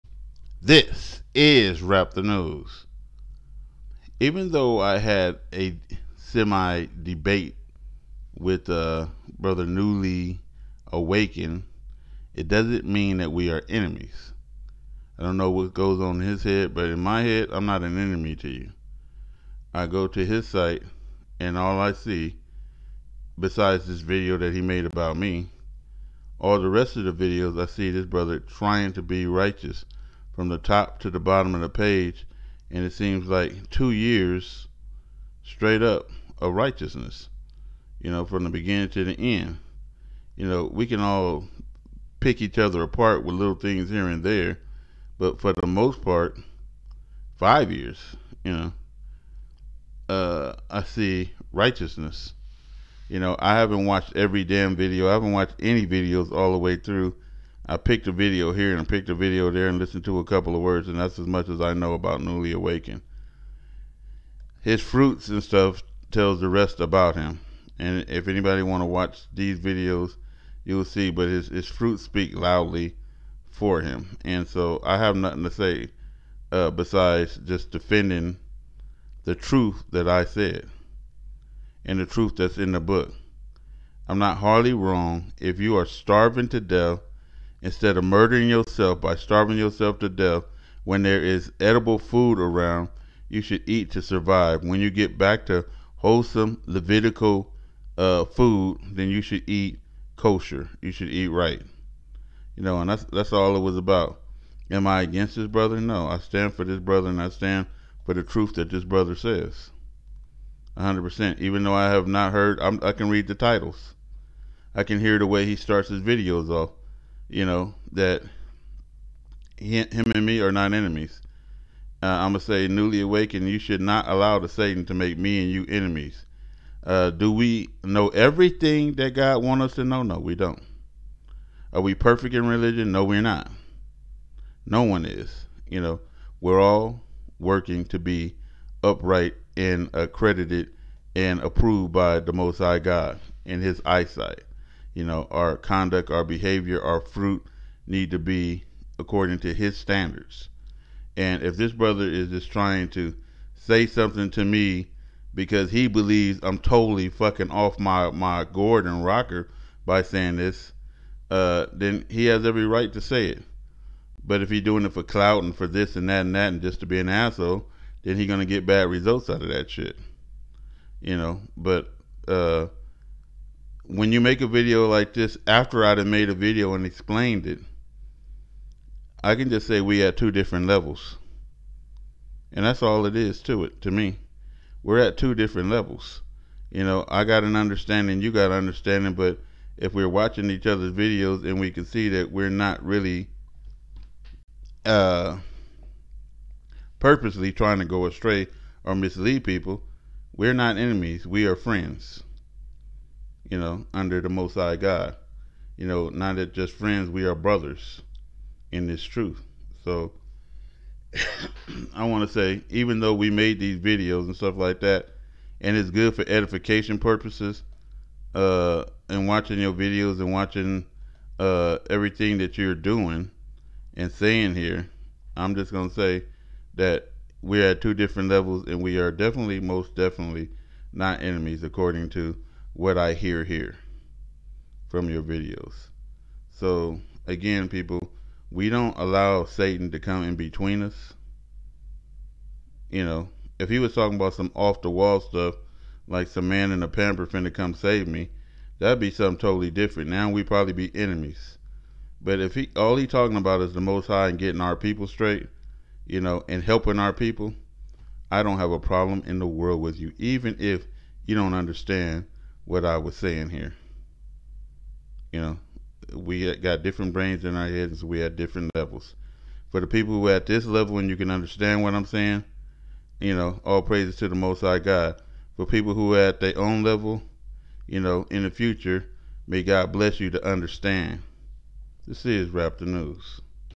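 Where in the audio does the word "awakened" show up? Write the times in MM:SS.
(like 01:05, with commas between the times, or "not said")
00:10, 01:02, 02:03.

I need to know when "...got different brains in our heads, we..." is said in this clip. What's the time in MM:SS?
04:26.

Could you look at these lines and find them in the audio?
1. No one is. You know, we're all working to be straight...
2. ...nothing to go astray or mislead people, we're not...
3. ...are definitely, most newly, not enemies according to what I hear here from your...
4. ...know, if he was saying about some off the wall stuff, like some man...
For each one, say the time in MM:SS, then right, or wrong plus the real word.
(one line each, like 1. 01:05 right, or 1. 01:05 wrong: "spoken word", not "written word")
1. 02:14 wrong: "upright", not "straight"
2. 03:17 wrong: "trying", not "nothing"
3. 03:48 wrong: "definitely", not "newly"
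4. 04:03 wrong: "talking", not "saying".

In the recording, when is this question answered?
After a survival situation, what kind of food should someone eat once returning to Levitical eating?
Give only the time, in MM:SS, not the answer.
01:40.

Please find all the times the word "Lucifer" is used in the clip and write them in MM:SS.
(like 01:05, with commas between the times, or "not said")
not said.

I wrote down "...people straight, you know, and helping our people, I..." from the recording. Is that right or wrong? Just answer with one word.
right.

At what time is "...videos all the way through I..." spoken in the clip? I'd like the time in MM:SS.
00:55.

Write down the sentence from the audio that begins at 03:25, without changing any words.
You know, not that just friends, we are brothers in this truth.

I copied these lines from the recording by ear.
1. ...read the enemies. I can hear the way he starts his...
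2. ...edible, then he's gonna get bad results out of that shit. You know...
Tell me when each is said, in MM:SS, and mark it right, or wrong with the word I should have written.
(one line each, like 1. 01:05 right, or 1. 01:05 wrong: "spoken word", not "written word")
1. 01:53 wrong: "titles", not "enemies"
2. 02:47 wrong: "asshole", not "edible".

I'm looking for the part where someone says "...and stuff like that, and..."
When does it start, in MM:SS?
03:34.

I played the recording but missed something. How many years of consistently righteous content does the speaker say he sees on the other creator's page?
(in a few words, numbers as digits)
5.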